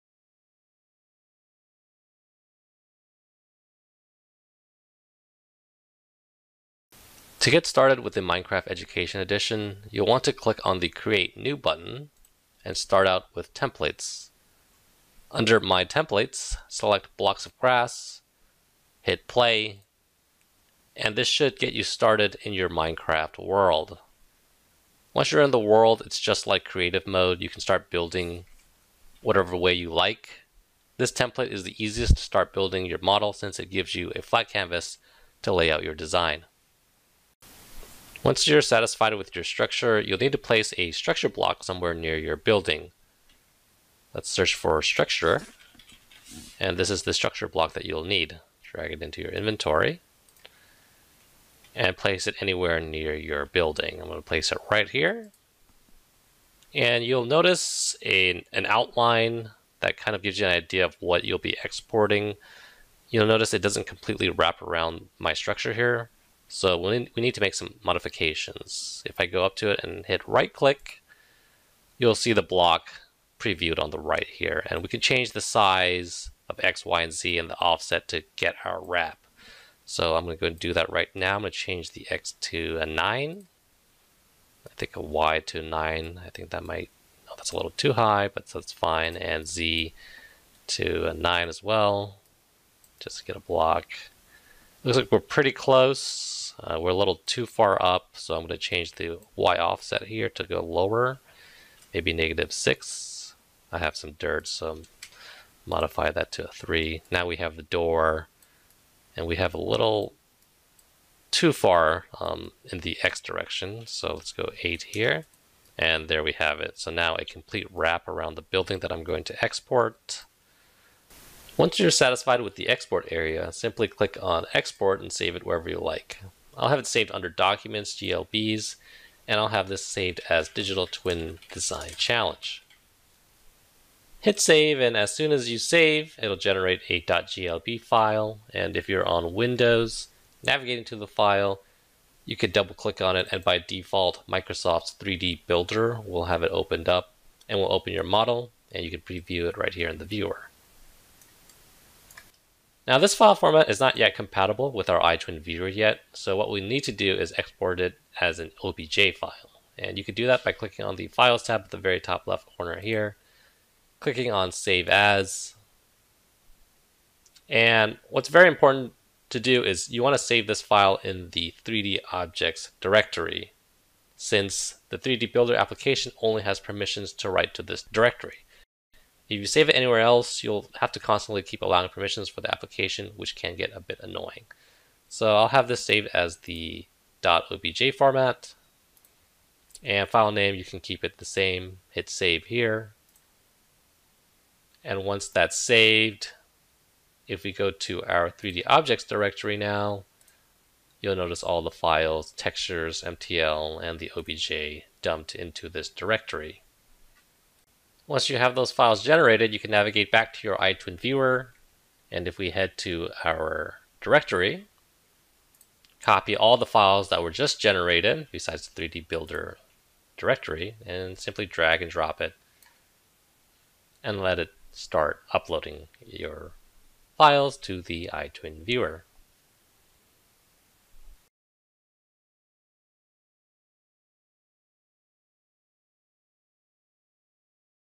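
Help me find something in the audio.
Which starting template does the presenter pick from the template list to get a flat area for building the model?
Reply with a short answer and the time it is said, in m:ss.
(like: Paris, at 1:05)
Blocks of Grass, at 0:17.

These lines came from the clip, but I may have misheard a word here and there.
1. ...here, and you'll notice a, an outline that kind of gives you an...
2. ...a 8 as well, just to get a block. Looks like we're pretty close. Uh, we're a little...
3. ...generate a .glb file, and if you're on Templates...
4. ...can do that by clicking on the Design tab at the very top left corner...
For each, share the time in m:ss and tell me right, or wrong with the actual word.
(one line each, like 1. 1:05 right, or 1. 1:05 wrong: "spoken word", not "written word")
1. 0:54 right
2. 1:31 wrong: "9", not "8"
3. 2:16 wrong: "Windows", not "Templates"
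4. 2:40 wrong: "Files", not "Design".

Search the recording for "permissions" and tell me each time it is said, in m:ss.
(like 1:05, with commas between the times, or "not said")
2:56, 3:01.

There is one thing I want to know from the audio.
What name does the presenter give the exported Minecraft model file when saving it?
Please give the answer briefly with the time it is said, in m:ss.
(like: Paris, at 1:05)
Digital Twin Design Challenge, at 2:10.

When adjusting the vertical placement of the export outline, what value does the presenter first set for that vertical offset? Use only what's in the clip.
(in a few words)
-6.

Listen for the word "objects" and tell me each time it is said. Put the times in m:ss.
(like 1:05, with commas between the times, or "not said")
2:52, 3:18.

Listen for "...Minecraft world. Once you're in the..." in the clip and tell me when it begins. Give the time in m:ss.
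0:22.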